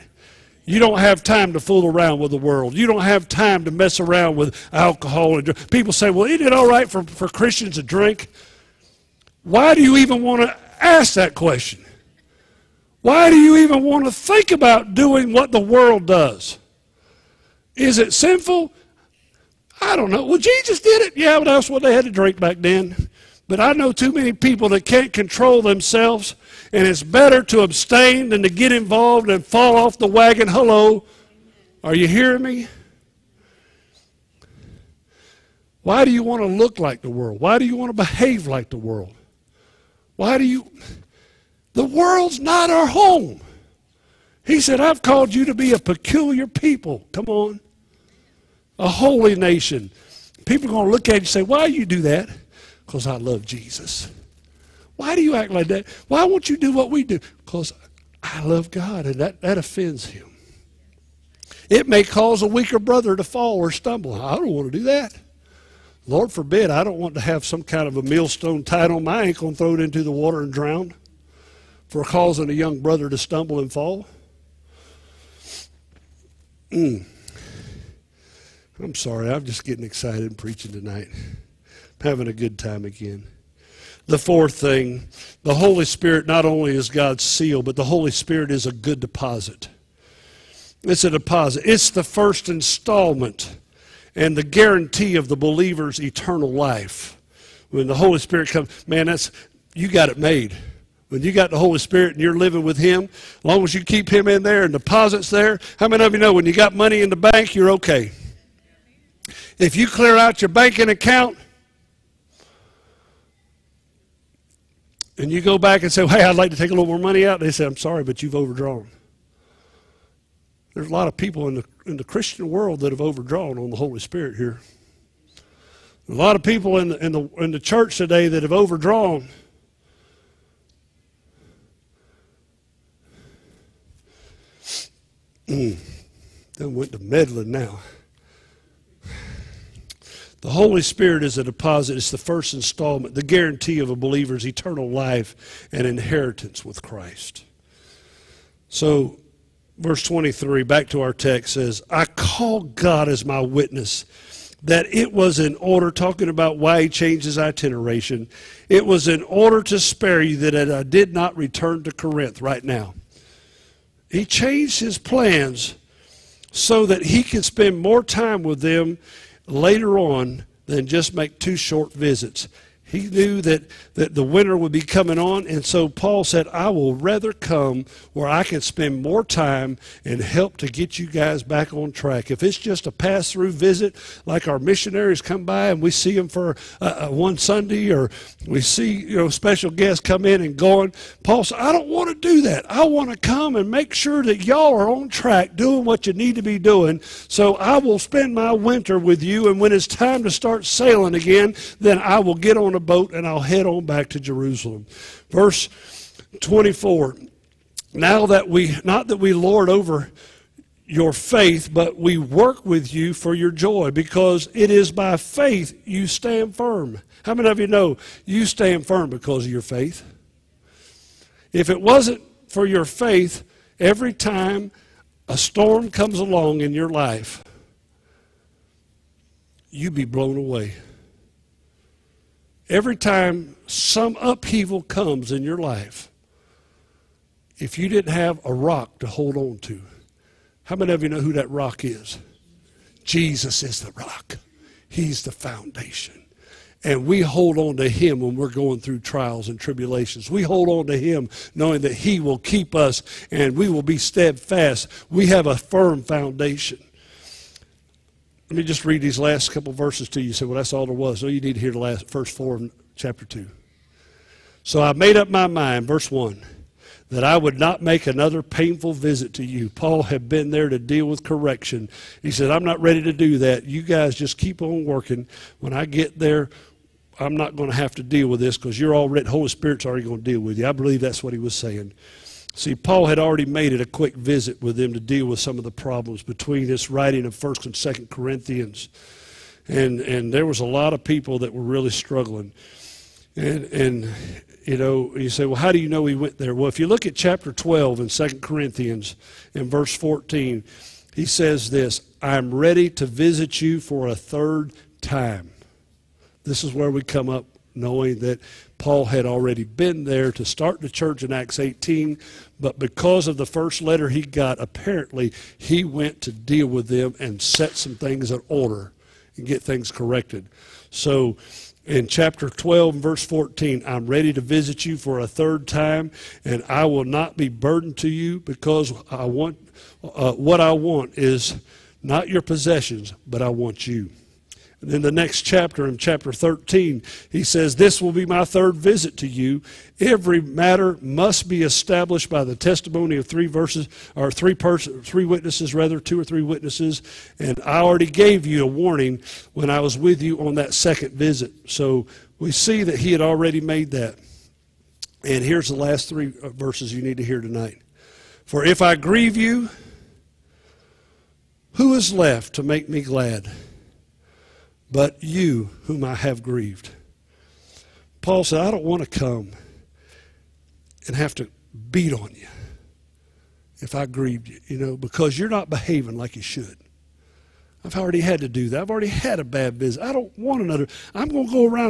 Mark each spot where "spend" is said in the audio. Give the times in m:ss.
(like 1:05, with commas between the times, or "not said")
2:47, 2:58, 3:17.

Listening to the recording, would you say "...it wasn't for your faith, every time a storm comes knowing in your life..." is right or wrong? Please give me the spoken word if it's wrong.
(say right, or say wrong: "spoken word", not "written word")
wrong: "along", not "knowing".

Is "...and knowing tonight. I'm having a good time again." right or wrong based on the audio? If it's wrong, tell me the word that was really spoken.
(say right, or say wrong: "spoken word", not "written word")
wrong: "preaching", not "knowing".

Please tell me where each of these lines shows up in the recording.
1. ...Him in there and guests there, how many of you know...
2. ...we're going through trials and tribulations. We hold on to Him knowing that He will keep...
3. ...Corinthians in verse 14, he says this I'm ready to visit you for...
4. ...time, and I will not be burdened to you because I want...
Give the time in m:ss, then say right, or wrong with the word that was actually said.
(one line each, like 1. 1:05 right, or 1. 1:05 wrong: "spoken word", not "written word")
1. 1:44 wrong: "deposits", not "guests"
2. 4:08 right
3. 4:58 right
4. 5:25 right.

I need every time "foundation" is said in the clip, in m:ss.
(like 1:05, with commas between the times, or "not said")
4:05, 4:16.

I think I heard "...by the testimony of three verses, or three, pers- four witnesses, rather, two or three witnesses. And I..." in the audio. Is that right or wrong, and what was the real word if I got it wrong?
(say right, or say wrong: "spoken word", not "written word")
wrong: "three", not "four".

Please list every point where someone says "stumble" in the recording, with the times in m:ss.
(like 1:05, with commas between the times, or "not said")
1:03, 1:13.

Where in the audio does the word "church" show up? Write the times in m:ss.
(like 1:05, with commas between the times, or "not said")
2:07, 5:10.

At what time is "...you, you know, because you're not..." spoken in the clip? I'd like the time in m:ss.
6:14.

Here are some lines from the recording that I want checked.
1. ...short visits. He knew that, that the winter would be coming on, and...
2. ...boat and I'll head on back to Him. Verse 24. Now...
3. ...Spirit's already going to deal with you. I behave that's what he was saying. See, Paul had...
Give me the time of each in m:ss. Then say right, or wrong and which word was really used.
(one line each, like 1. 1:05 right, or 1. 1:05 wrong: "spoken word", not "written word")
1. 2:51 right
2. 3:22 wrong: "Jerusalem", not "Him"
3. 4:39 wrong: "believe", not "behave".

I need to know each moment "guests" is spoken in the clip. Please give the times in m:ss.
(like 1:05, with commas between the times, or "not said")
3:09.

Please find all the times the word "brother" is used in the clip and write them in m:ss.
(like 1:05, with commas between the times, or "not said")
1:02, 1:12.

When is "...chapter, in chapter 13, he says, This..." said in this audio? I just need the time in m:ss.
5:35.